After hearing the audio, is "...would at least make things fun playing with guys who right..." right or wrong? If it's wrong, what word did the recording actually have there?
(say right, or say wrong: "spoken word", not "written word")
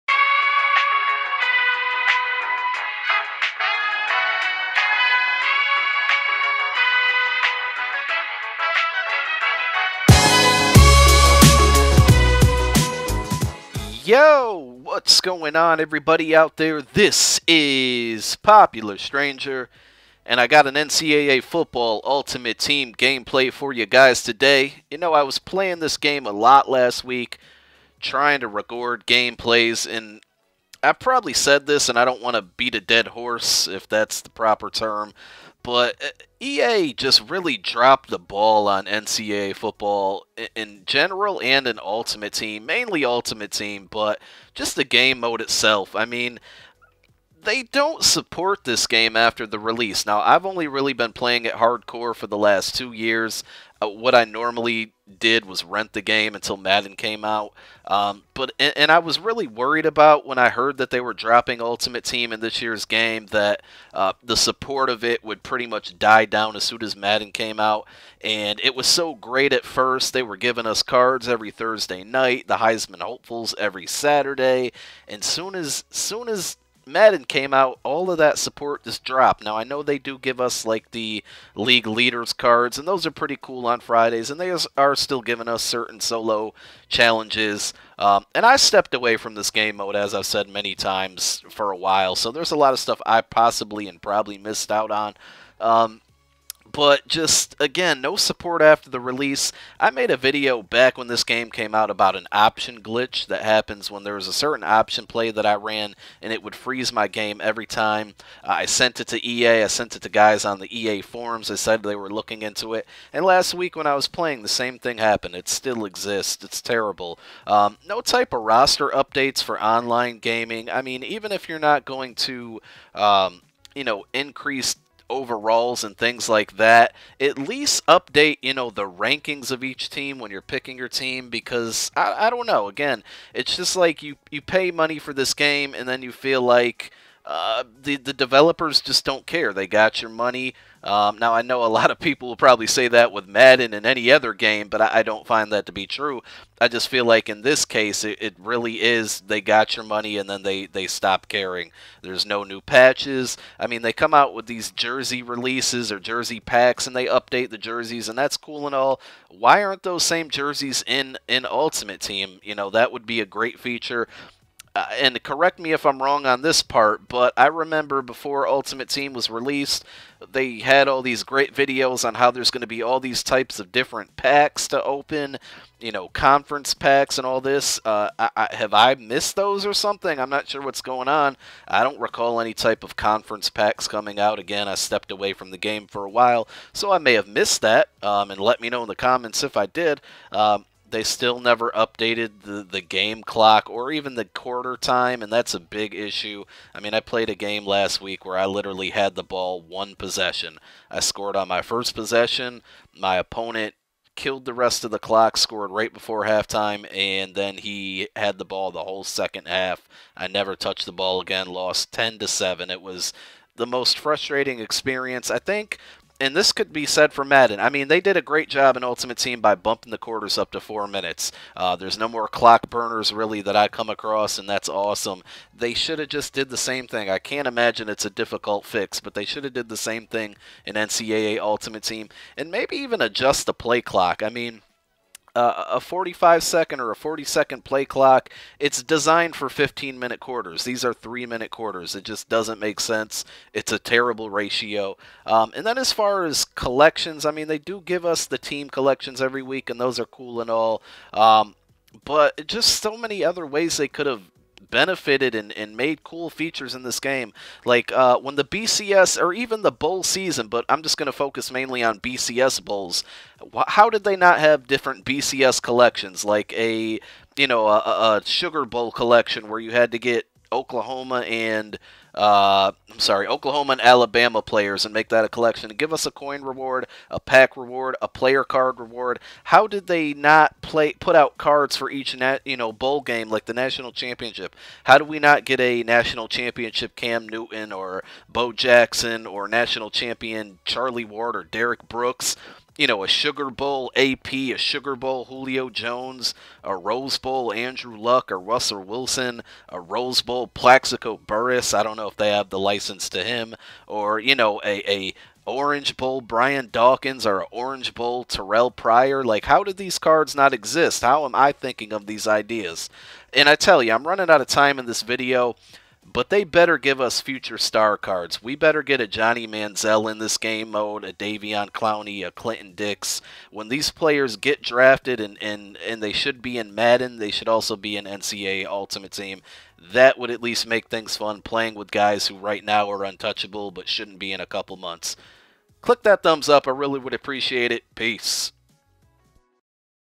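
right.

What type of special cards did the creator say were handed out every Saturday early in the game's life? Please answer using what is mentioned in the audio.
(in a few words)
Heisman hopefuls.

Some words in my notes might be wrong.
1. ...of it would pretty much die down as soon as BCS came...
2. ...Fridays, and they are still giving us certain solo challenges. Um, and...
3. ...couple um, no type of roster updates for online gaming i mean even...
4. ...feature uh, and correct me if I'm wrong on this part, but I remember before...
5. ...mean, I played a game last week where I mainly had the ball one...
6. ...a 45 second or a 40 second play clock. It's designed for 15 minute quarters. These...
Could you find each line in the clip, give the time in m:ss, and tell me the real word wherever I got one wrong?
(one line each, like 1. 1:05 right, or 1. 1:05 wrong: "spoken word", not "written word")
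1. 1:04 wrong: "Madden", not "BCS"
2. 1:23 right
3. 1:56 wrong: "terrible", not "couple"
4. 2:43 right
5. 3:16 wrong: "literally", not "mainly"
6. 3:55 right.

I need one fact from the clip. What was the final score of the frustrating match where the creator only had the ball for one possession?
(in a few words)
10 to 7.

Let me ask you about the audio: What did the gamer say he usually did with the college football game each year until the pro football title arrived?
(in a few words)
Rent the game.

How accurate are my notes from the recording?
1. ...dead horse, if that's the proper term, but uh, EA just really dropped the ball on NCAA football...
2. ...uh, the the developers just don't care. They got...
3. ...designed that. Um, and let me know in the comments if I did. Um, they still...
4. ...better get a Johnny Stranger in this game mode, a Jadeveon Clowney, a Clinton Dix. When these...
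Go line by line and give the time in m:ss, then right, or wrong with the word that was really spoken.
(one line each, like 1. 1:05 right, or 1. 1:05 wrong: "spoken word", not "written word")
1. 0:32 right
2. 2:17 right
3. 3:07 wrong: "missed", not "designed"
4. 5:18 wrong: "Manziel", not "Stranger".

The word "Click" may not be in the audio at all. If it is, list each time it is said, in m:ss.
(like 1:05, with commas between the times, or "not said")
5:35.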